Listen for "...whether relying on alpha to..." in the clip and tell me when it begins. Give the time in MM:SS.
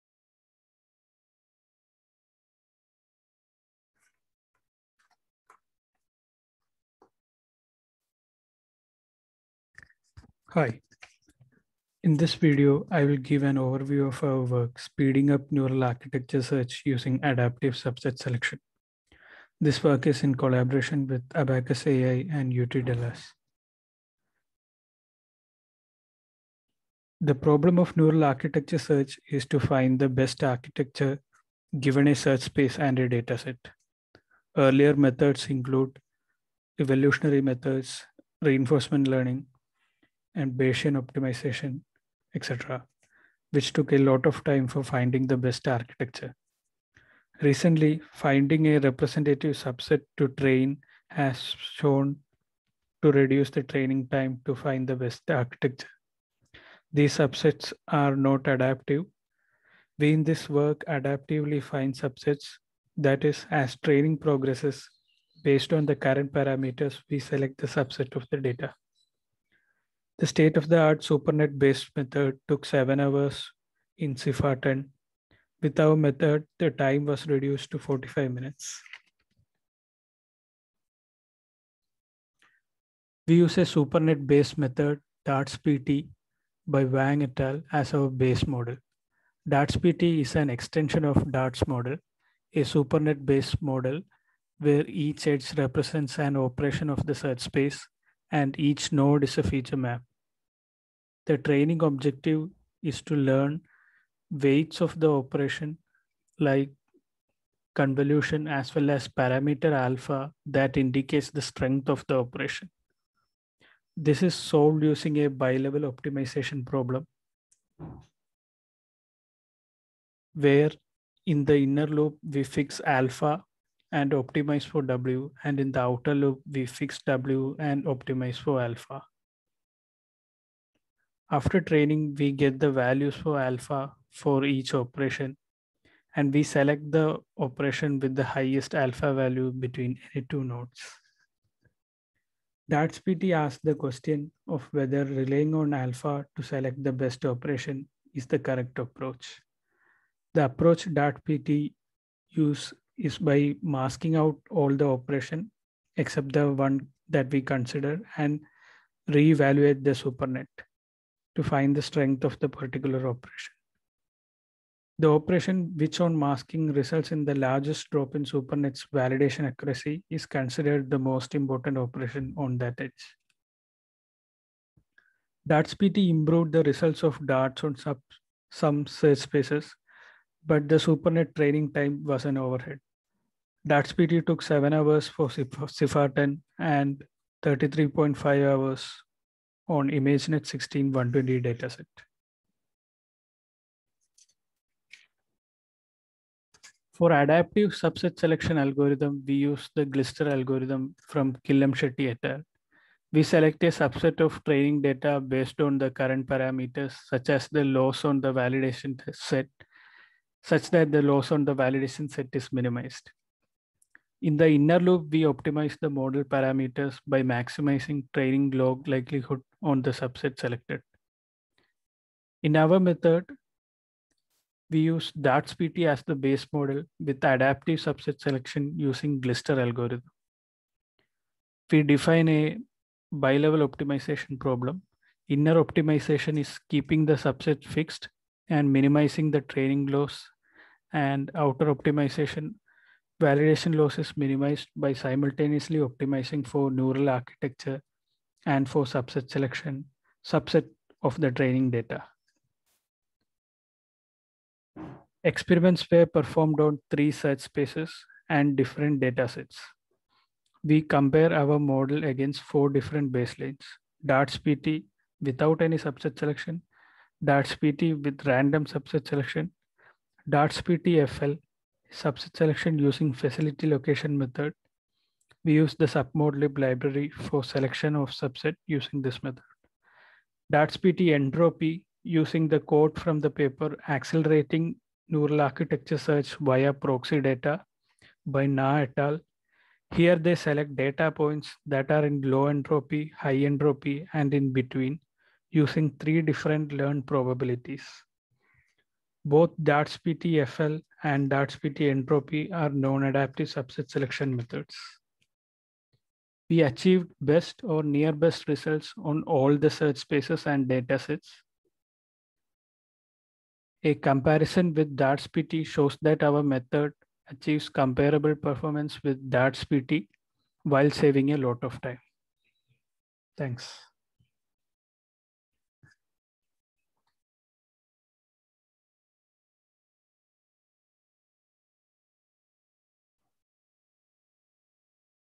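02:24.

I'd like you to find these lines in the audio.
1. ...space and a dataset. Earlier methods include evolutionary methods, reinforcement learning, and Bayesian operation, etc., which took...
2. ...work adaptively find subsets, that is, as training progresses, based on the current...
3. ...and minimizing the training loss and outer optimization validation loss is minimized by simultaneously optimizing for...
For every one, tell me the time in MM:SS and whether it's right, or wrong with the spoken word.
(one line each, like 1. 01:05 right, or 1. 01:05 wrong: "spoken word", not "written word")
1. 00:32 wrong: "optimization", not "operation"
2. 01:00 right
3. 03:58 right.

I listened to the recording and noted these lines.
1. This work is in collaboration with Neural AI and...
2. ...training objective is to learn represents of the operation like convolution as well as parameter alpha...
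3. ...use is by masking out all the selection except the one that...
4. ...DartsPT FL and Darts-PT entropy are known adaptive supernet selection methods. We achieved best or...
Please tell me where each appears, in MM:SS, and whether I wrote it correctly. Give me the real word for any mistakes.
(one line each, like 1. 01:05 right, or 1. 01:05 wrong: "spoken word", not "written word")
1. 00:19 wrong: "Abacus", not "Neural"
2. 01:41 wrong: "weights", not "represents"
3. 02:32 wrong: "operation", not "selection"
4. 04:59 wrong: "subset", not "supernet".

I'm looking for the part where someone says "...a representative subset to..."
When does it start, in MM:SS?
00:48.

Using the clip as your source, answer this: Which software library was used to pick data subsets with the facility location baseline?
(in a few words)
submodlib.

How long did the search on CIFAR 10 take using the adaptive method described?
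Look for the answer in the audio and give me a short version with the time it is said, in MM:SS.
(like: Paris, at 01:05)
45 minutes, at 01:17.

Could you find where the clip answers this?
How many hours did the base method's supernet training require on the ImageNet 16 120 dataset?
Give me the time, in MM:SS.
03:07.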